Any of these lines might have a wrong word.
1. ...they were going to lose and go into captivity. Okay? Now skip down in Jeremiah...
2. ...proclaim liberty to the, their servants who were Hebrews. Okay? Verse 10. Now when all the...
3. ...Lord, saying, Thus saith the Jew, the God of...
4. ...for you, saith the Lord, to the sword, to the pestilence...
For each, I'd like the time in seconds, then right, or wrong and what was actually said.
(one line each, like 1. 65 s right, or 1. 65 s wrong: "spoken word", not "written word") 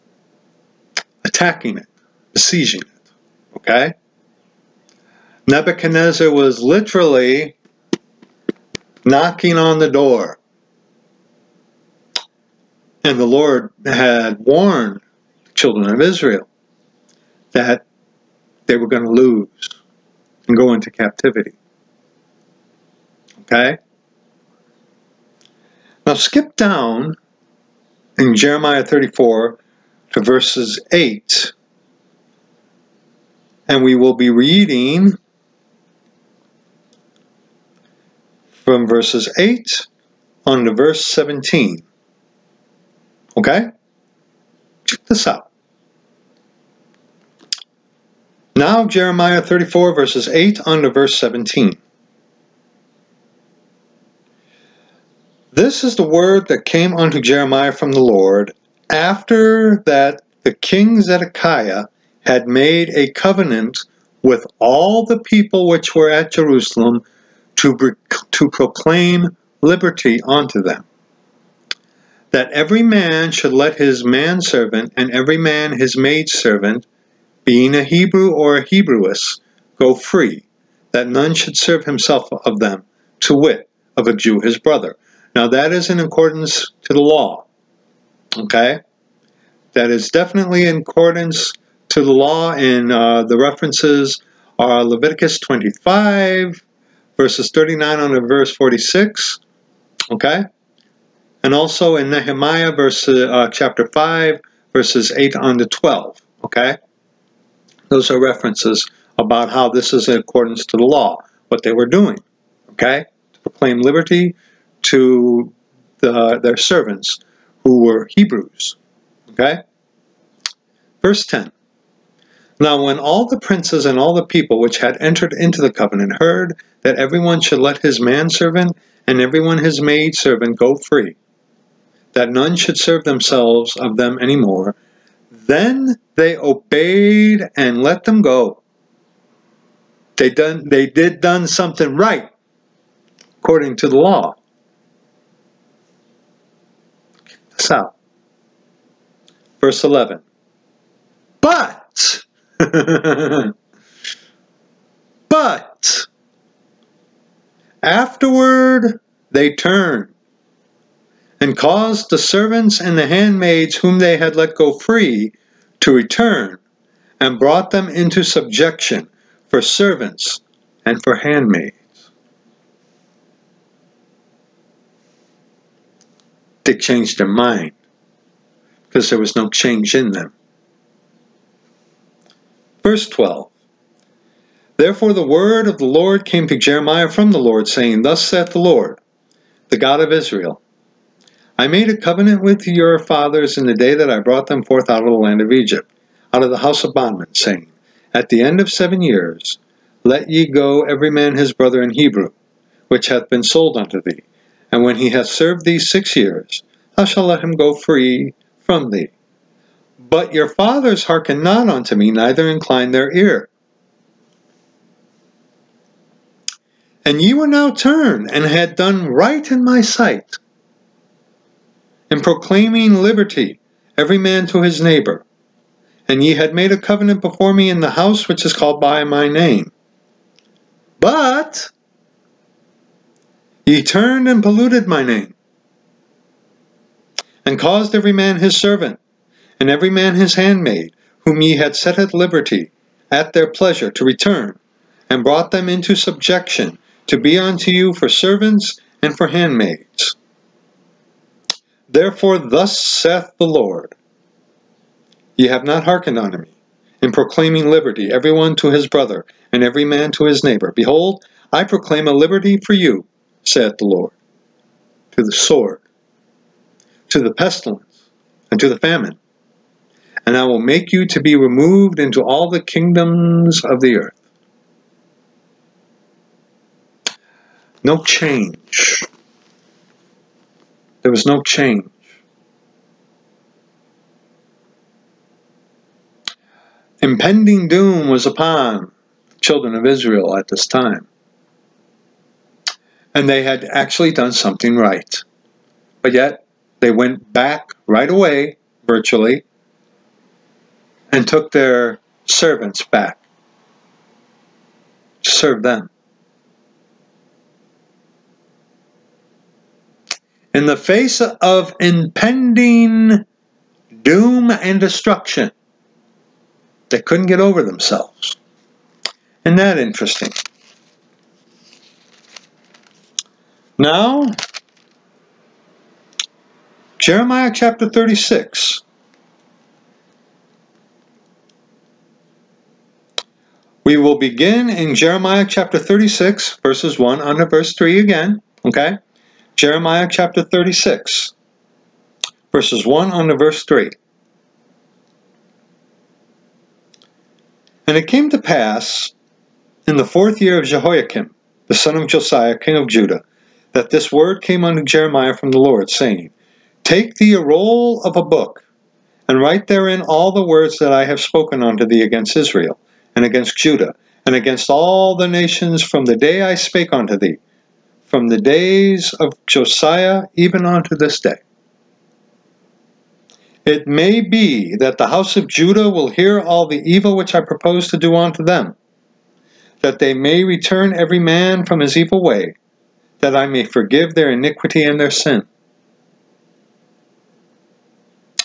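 1. 18 s right
2. 113 s right
3. 187 s wrong: "Lord", not "Jew"
4. 262 s right.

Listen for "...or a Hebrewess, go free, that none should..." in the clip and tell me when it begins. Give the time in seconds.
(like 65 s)
78 s.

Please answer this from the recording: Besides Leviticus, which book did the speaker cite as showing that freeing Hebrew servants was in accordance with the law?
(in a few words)
Nehemiah.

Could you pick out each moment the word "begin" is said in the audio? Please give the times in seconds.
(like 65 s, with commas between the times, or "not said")
334 s.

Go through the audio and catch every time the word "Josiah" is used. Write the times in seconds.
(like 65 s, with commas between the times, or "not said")
352 s, 369 s.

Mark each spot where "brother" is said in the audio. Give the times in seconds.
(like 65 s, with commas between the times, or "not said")
84 s, 201 s, 258 s.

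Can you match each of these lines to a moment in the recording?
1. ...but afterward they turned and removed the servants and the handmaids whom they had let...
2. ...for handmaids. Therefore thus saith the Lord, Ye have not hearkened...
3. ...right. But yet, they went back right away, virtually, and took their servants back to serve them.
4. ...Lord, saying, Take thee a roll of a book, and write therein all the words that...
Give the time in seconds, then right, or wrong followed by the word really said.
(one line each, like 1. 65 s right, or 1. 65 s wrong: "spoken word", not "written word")
1. 155 s wrong: "caused", not "removed"
2. 249 s right
3. 294 s right
4. 355 s right.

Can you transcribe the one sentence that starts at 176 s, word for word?
They changed their mind because there was no change in them.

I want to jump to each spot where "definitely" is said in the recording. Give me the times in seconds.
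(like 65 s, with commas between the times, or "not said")
90 s.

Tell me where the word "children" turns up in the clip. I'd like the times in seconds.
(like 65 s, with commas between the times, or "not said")
15 s, 289 s.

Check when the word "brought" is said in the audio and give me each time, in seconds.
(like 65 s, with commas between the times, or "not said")
167 s, 194 s, 245 s.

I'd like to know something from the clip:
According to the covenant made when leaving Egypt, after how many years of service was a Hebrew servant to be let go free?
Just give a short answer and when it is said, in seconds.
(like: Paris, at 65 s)
6, at 205 s.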